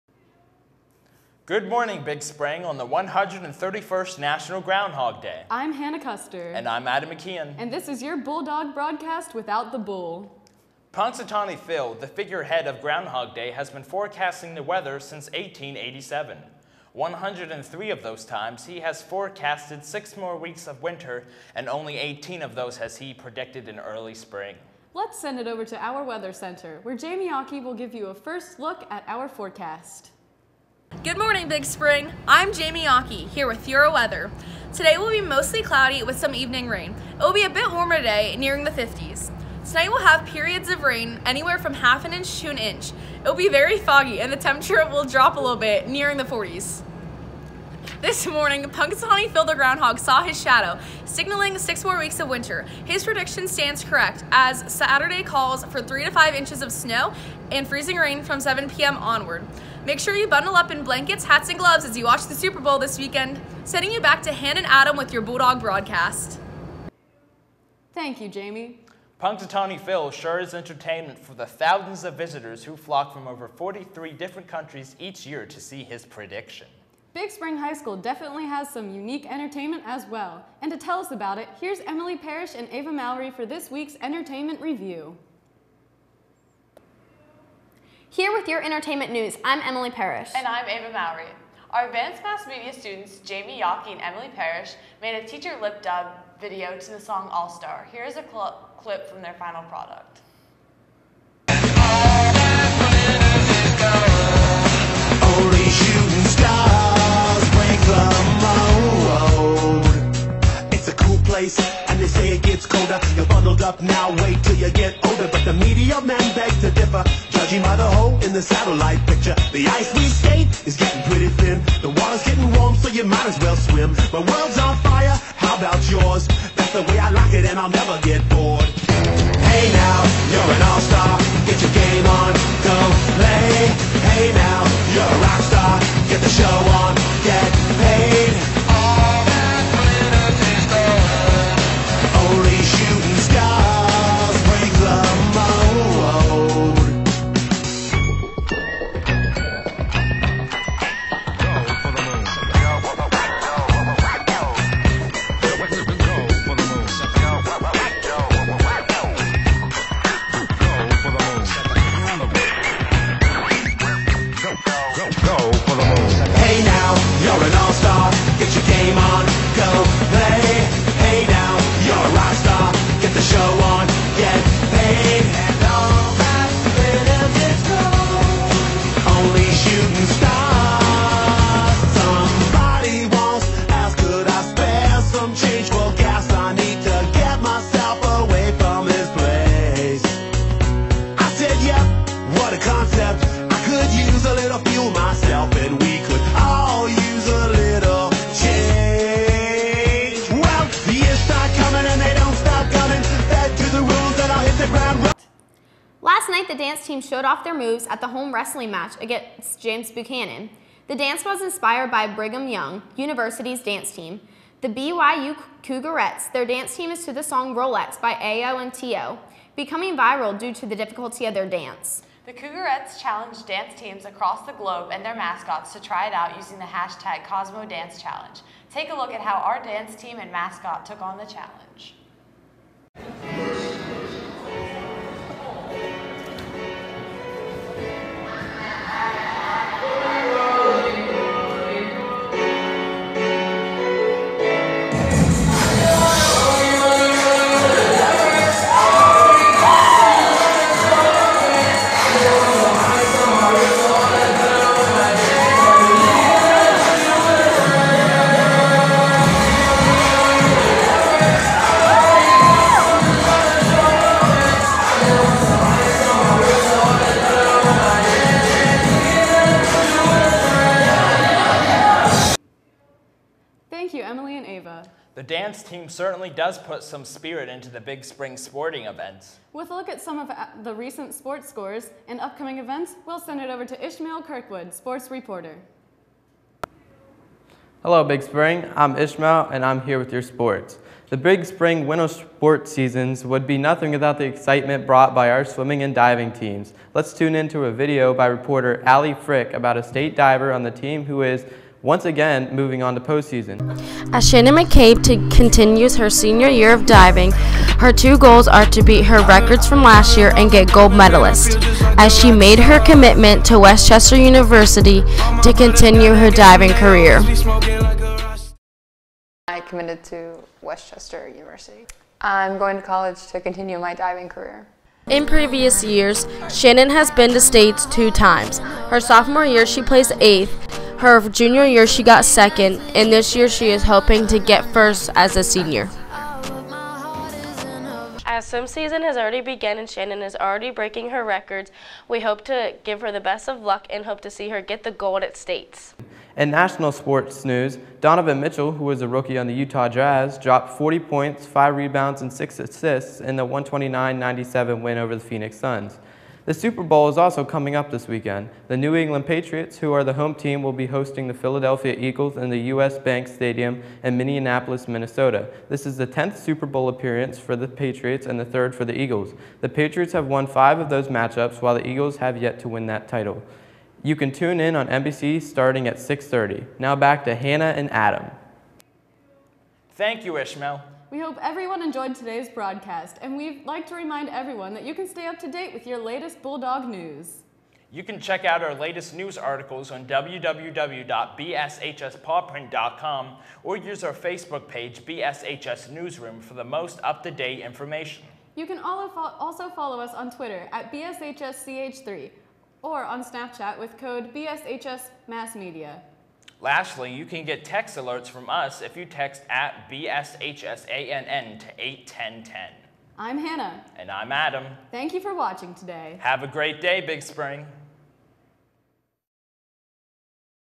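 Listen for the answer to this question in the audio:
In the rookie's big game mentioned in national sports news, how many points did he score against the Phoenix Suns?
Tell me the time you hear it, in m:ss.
5:50.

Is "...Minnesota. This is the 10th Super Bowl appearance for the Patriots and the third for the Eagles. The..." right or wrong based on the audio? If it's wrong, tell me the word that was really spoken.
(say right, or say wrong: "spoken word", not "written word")
right.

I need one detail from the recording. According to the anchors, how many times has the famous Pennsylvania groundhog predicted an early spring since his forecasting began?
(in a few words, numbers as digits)
18.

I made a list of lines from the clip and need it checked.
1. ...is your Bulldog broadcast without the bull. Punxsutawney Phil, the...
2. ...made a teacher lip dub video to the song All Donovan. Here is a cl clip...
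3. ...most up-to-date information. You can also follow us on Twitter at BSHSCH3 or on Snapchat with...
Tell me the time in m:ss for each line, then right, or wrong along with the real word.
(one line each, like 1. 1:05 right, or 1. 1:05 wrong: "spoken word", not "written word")
1. 0:07 right
2. 1:35 wrong: "Star", not "Donovan"
3. 6:36 right.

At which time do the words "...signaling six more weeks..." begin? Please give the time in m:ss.
0:51.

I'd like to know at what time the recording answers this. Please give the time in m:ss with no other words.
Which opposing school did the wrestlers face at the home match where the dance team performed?
3:29.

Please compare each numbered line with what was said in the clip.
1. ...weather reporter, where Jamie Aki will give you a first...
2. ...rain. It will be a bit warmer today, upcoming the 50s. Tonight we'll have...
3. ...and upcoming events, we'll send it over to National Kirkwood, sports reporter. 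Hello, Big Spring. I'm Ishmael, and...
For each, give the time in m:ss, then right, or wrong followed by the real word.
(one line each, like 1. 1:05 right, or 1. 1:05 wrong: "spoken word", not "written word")
1. 0:26 wrong: "center", not "reporter"
2. 0:36 wrong: "nearing", not "upcoming"
3. 4:42 wrong: "Ishmael", not "National".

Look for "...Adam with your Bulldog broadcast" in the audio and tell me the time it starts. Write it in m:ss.
1:04.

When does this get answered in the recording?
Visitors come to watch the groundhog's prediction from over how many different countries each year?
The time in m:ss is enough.
1:13.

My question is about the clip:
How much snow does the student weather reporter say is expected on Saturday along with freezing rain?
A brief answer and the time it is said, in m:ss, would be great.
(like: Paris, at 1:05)
3 to 5 inches, at 0:55.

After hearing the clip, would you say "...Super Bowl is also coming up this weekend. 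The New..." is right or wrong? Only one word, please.
right.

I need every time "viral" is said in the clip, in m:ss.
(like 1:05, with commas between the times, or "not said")
3:39.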